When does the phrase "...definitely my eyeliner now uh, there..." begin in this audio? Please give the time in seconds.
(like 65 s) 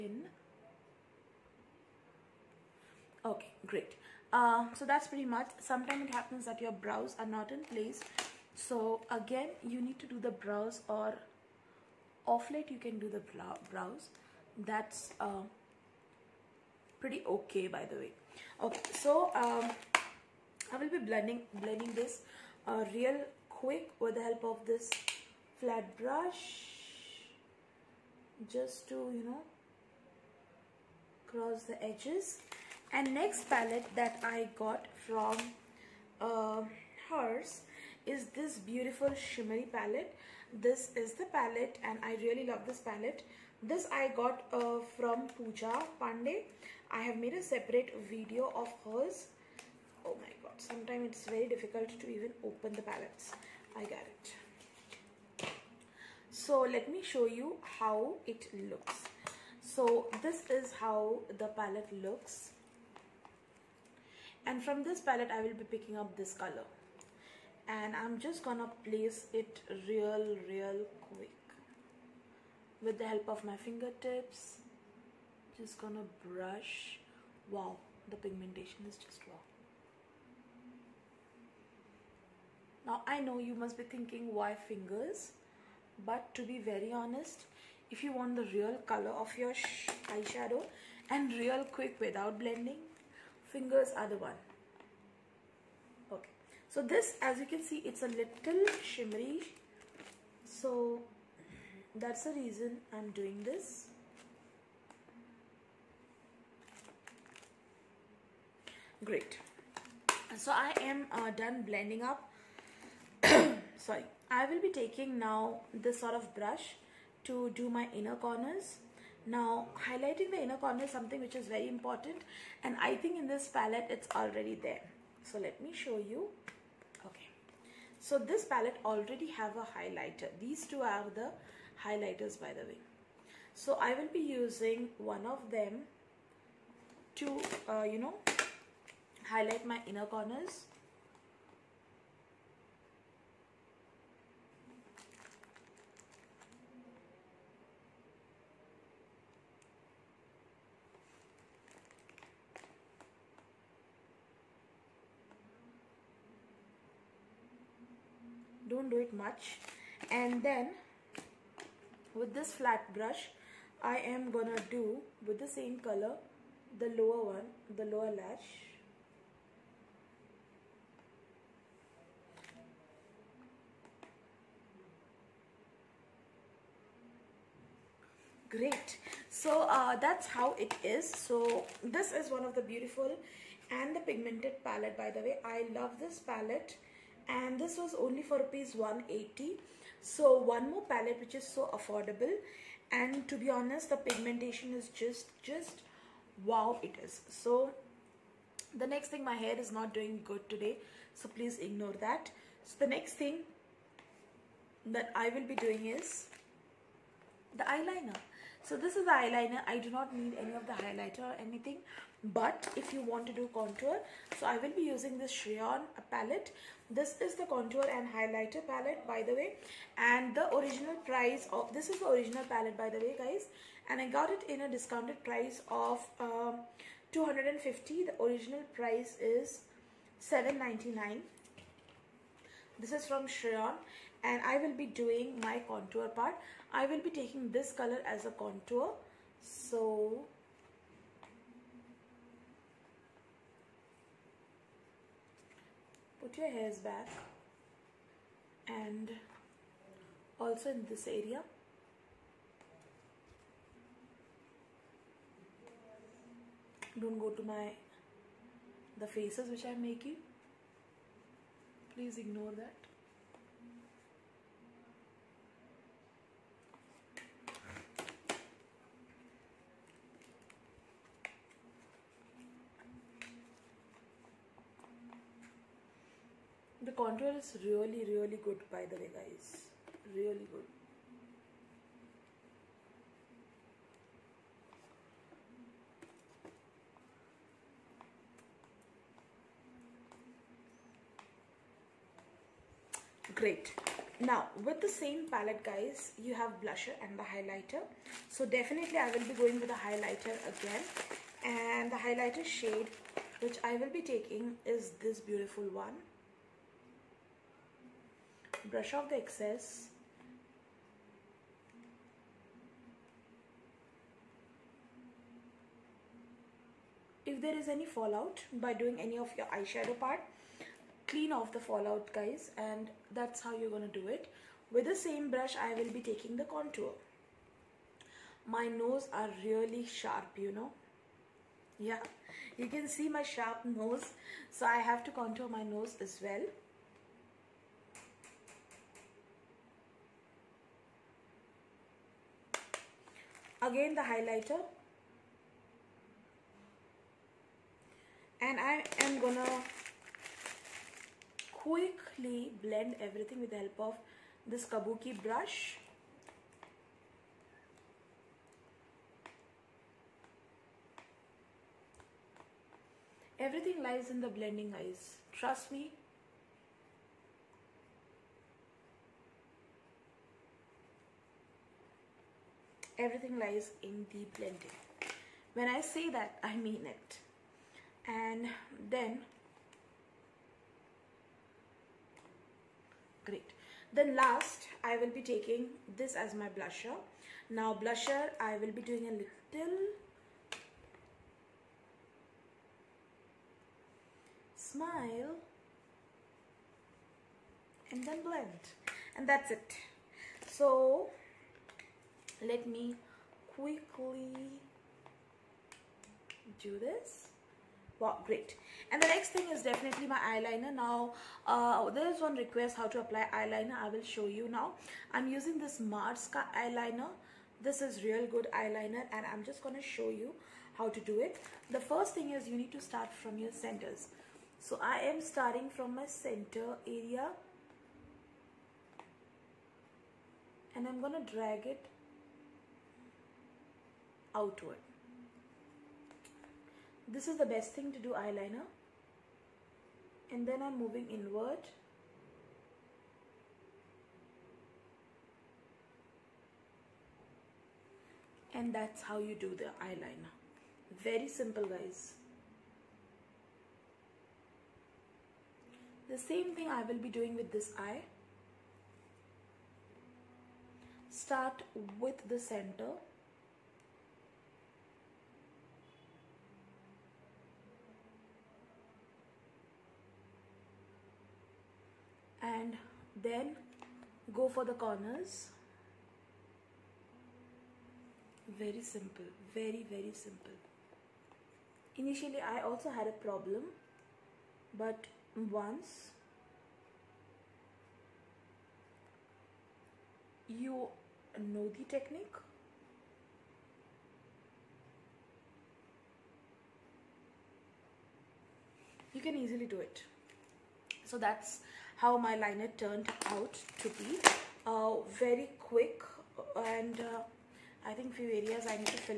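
409 s.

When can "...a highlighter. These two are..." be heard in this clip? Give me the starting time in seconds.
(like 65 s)
129 s.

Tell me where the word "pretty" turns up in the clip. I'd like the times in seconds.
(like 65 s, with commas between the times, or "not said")
5 s, 16 s.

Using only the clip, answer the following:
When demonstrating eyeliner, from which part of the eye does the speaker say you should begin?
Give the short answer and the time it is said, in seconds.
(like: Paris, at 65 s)
the center, at 423 s.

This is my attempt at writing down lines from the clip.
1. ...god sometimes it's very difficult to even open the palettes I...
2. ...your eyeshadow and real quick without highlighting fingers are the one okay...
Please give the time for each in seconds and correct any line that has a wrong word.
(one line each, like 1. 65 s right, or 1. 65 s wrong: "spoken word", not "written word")
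1. 50 s right
2. 89 s wrong: "blending", not "highlighting".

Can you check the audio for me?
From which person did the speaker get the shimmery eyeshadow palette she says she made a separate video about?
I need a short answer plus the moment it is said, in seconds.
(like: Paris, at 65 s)
Pooja Pandey, at 45 s.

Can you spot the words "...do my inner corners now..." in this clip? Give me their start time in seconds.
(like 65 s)
117 s.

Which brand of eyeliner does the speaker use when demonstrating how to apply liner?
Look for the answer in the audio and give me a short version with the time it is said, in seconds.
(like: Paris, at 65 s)
Mars, at 415 s.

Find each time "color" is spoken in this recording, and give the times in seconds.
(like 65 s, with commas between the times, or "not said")
66 s, 88 s, 165 s, 237 s.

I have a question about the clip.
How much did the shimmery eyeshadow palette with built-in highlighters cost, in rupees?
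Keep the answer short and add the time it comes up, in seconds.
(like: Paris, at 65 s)
180, at 188 s.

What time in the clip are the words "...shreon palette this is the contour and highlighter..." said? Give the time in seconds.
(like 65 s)
215 s.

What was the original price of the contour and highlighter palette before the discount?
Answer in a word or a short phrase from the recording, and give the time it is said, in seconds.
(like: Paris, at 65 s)
799, at 230 s.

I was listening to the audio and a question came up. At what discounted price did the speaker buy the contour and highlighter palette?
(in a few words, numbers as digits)
250.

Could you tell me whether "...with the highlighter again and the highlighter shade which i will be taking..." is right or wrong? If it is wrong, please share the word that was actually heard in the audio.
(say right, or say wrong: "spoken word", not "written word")
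right.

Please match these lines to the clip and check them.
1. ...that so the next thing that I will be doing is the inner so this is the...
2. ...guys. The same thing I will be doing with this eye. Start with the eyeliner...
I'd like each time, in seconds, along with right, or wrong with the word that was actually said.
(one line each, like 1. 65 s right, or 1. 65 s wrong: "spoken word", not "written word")
1. 202 s wrong: "eyeliner", not "inner"
2. 451 s wrong: "center", not "eyeliner".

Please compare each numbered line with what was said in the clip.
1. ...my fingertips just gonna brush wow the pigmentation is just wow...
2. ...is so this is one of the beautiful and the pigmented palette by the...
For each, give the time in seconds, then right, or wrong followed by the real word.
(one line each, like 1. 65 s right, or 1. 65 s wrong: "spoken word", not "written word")
1. 73 s right
2. 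180 s right.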